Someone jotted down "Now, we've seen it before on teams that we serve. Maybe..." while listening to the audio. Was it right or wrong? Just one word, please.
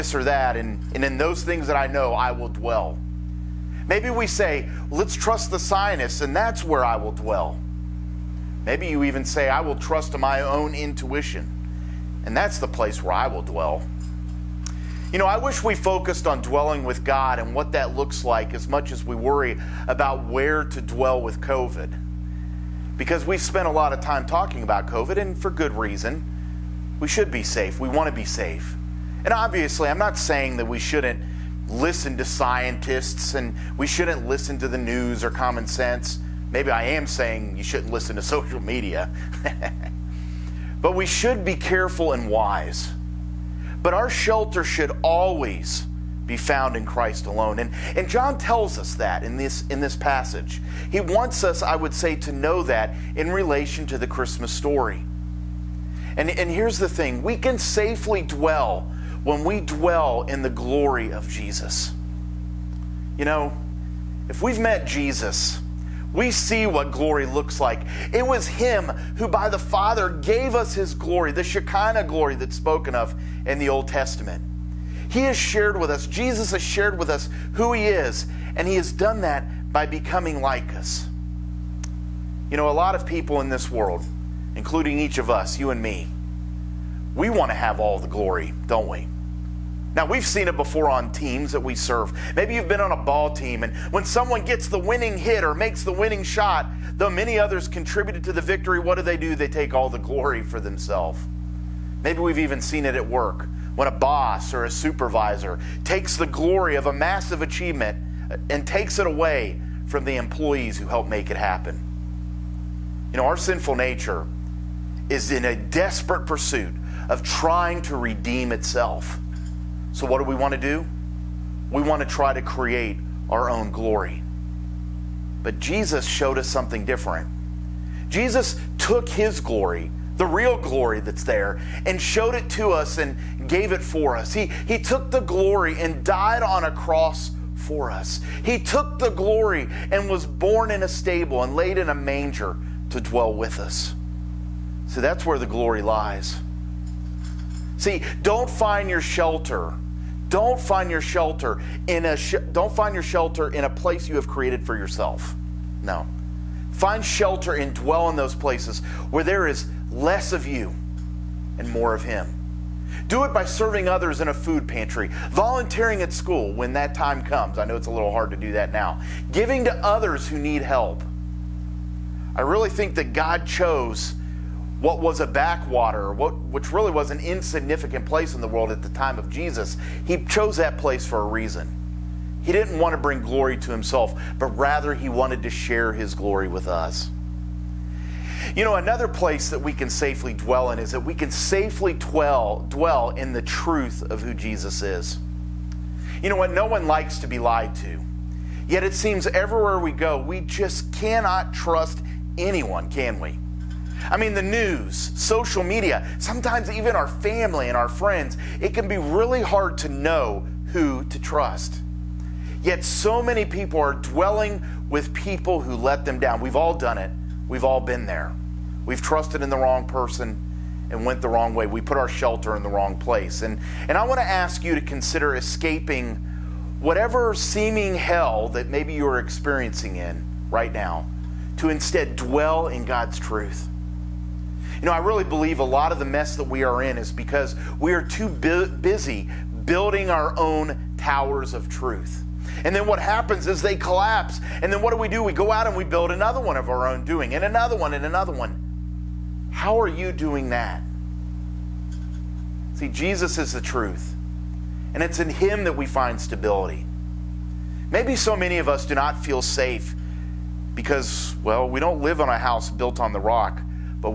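right.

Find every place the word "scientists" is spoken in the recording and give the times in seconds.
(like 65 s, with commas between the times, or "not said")
5 s, 32 s.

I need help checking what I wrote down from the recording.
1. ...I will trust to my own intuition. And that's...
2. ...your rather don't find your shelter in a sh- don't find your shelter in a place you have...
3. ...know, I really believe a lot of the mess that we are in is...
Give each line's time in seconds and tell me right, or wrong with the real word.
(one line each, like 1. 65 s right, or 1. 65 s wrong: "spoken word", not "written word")
1. 9 s right
2. 148 s wrong: "shelter", not "rather"
3. 234 s right.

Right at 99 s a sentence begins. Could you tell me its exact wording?
They take all the glory for themselves.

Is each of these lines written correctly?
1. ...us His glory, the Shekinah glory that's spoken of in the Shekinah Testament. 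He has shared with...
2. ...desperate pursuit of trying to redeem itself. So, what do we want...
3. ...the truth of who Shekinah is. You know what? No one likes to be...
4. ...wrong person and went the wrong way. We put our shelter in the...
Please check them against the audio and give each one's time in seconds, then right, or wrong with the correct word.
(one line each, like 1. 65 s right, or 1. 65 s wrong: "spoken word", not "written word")
1. 70 s wrong: "Old", not "Shekinah"
2. 115 s right
3. 193 s wrong: "Jesus", not "Shekinah"
4. 219 s right.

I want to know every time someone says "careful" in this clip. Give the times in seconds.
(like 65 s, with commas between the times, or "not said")
41 s.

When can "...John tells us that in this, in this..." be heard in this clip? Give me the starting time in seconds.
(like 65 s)
48 s.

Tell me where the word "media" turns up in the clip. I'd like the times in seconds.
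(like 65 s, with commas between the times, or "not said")
38 s, 205 s.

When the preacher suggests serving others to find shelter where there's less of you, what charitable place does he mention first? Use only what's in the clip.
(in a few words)
food pantry.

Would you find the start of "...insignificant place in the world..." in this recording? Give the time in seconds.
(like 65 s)
177 s.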